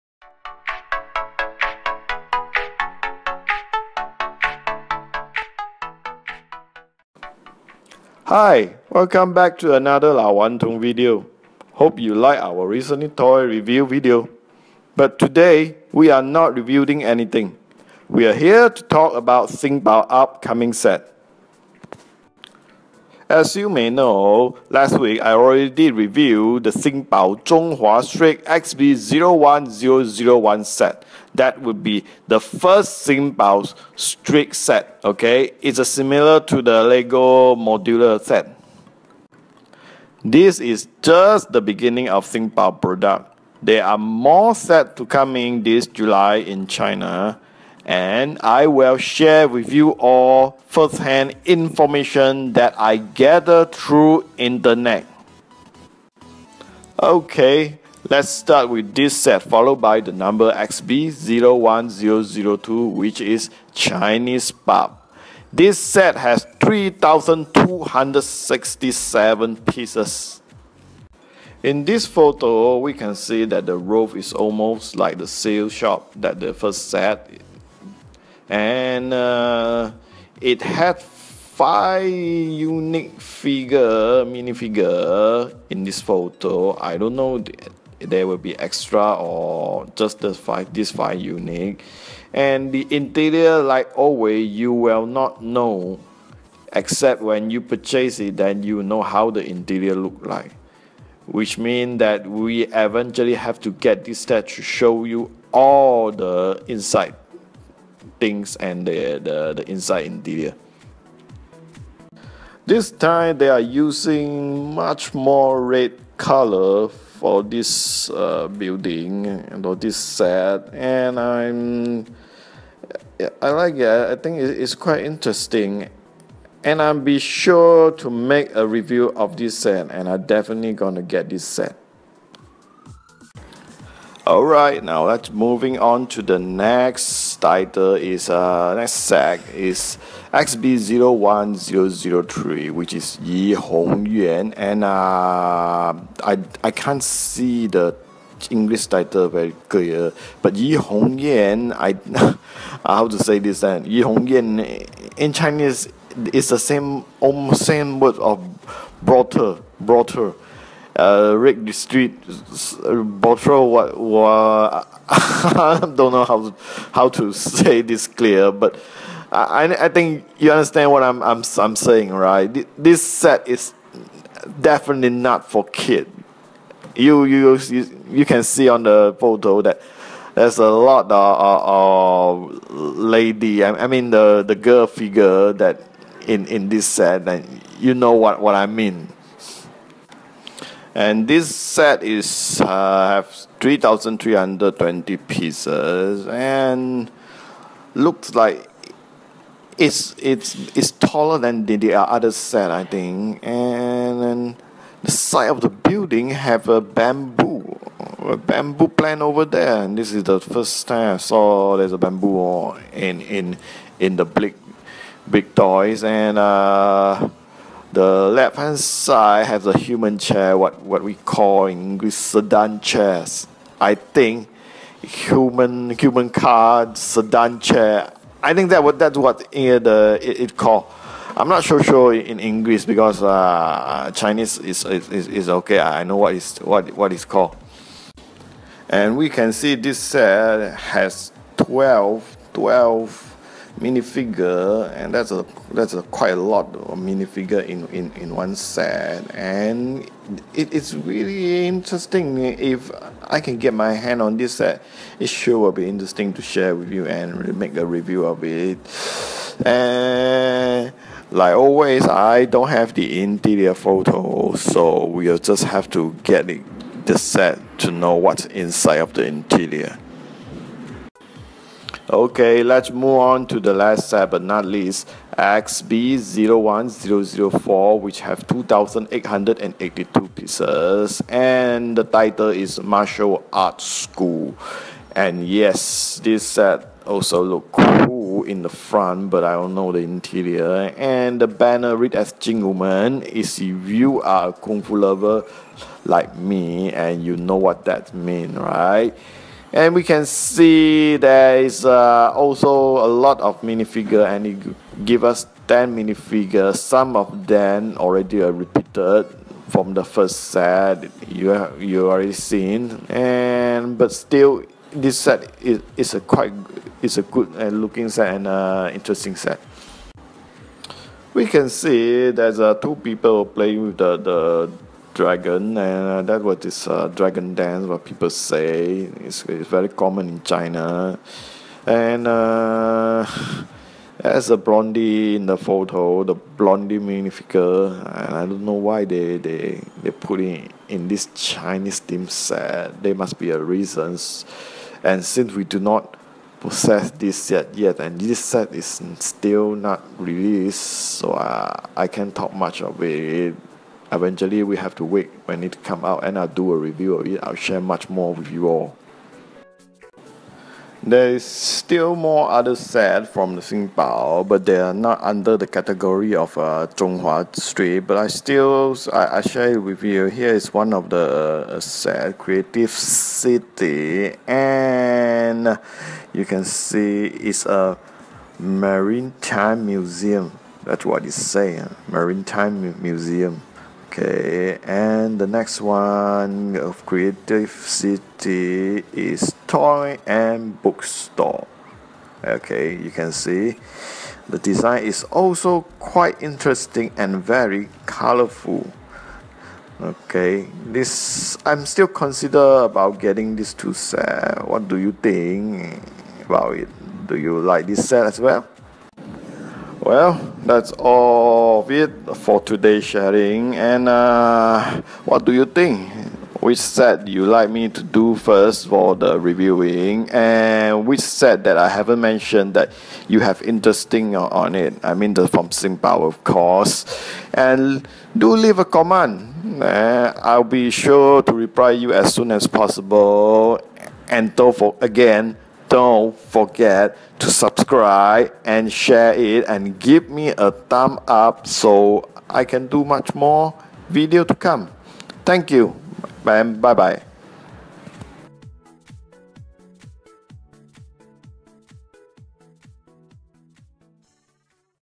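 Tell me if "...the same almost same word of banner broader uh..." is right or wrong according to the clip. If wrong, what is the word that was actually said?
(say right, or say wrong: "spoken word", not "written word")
wrong: "broader", not "banner".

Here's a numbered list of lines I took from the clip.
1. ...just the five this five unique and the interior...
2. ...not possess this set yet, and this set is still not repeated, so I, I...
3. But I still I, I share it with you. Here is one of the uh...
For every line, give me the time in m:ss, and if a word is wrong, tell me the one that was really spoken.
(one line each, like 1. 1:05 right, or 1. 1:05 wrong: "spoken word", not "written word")
1. 1:29 right
2. 5:45 wrong: "released", not "repeated"
3. 6:08 right.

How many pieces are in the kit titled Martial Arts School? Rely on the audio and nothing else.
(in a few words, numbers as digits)
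2882.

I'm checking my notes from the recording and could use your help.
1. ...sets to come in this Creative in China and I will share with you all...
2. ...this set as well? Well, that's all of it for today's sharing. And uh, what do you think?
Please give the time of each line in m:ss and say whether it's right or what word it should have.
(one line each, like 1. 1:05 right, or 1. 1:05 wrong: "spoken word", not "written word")
1. 0:44 wrong: "July", not "Creative"
2. 6:47 right.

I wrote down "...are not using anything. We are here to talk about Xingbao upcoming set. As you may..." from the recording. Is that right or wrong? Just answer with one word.
wrong.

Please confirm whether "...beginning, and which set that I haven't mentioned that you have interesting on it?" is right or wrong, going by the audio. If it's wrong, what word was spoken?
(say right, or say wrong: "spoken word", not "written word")
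wrong: "reviewing", not "beginning".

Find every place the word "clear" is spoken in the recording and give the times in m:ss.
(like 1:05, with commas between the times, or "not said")
2:29, 2:48.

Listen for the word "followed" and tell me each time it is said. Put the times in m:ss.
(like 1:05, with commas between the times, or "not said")
0:59.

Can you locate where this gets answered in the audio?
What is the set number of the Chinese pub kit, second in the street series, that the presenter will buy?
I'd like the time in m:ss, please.
1:00.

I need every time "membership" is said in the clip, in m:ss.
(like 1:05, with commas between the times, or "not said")
not said.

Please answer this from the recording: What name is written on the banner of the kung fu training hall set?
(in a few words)
Jing Wu Men.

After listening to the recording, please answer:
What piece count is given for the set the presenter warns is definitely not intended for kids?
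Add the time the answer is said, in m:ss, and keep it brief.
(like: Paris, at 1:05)
3,320, at 3:13.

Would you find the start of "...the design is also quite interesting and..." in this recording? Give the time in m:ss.
6:34.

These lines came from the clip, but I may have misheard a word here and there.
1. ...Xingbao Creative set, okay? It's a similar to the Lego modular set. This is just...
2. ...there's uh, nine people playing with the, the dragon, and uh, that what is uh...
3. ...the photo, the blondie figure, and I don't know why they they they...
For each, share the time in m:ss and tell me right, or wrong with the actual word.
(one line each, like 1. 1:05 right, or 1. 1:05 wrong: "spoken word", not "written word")
1. 0:33 wrong: "Street", not "Creative"
2. 5:22 wrong: "two", not "nine"
3. 5:35 wrong: "minifigure", not "figure".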